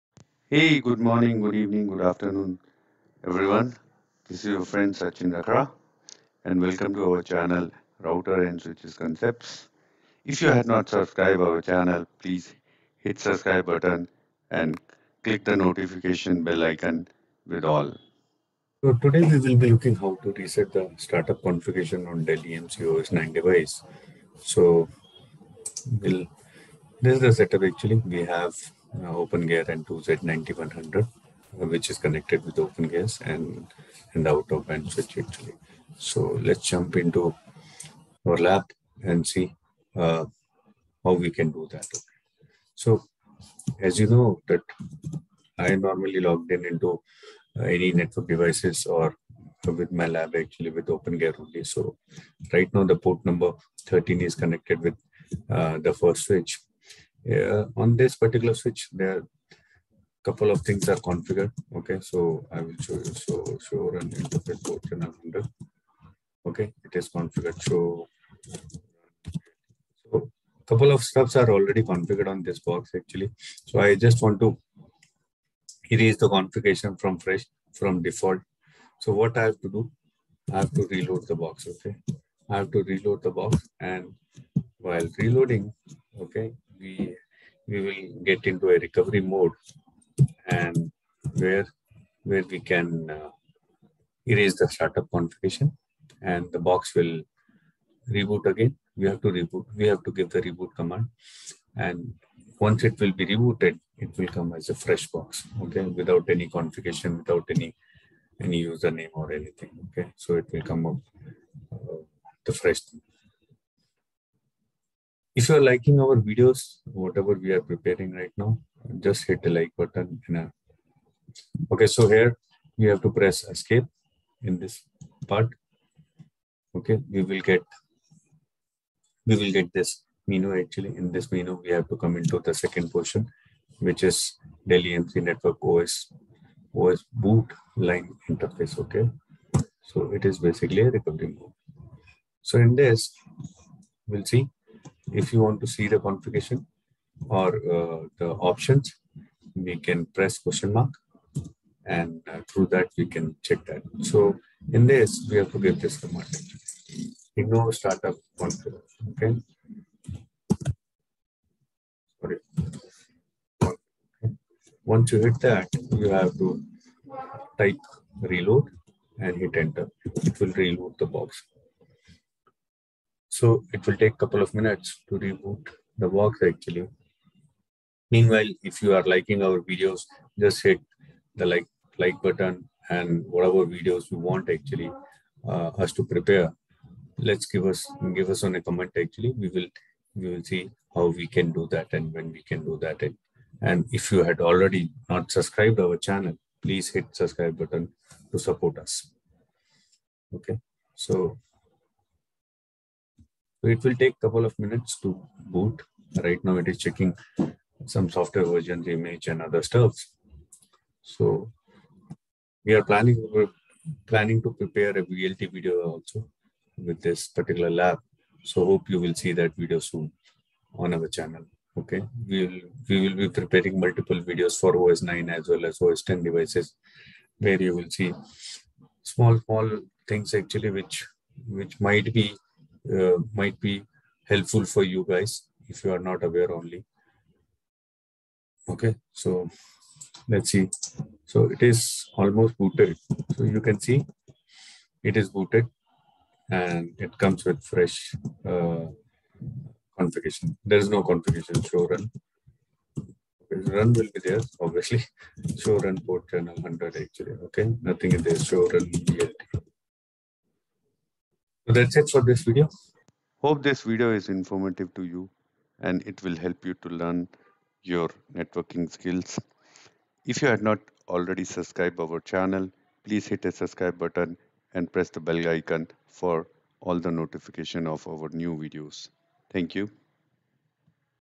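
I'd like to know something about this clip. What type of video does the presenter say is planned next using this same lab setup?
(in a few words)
VLT.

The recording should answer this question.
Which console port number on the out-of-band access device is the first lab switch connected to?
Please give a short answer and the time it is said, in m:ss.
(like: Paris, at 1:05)
13, at 0:52.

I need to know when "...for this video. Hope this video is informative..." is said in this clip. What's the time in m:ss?
4:22.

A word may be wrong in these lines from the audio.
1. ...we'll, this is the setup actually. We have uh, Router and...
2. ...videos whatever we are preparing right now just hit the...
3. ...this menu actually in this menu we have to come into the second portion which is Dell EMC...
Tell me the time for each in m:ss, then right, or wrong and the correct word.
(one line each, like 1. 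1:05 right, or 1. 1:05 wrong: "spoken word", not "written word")
1. 0:26 wrong: "OpenGear", not "Router"
2. 1:56 right
3. 2:09 right.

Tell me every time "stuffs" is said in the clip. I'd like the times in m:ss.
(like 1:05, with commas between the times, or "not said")
1:11, 3:29.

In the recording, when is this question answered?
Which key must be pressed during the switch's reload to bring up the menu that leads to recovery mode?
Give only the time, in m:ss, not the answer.
2:03.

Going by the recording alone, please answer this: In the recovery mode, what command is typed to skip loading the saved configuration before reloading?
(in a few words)
ignore startup config.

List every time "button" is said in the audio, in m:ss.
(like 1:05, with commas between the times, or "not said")
0:13, 1:59, 3:02, 3:17, 4:33.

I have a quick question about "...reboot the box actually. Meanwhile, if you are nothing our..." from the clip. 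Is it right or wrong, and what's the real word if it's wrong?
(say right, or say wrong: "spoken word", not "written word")
wrong: "liking", not "nothing".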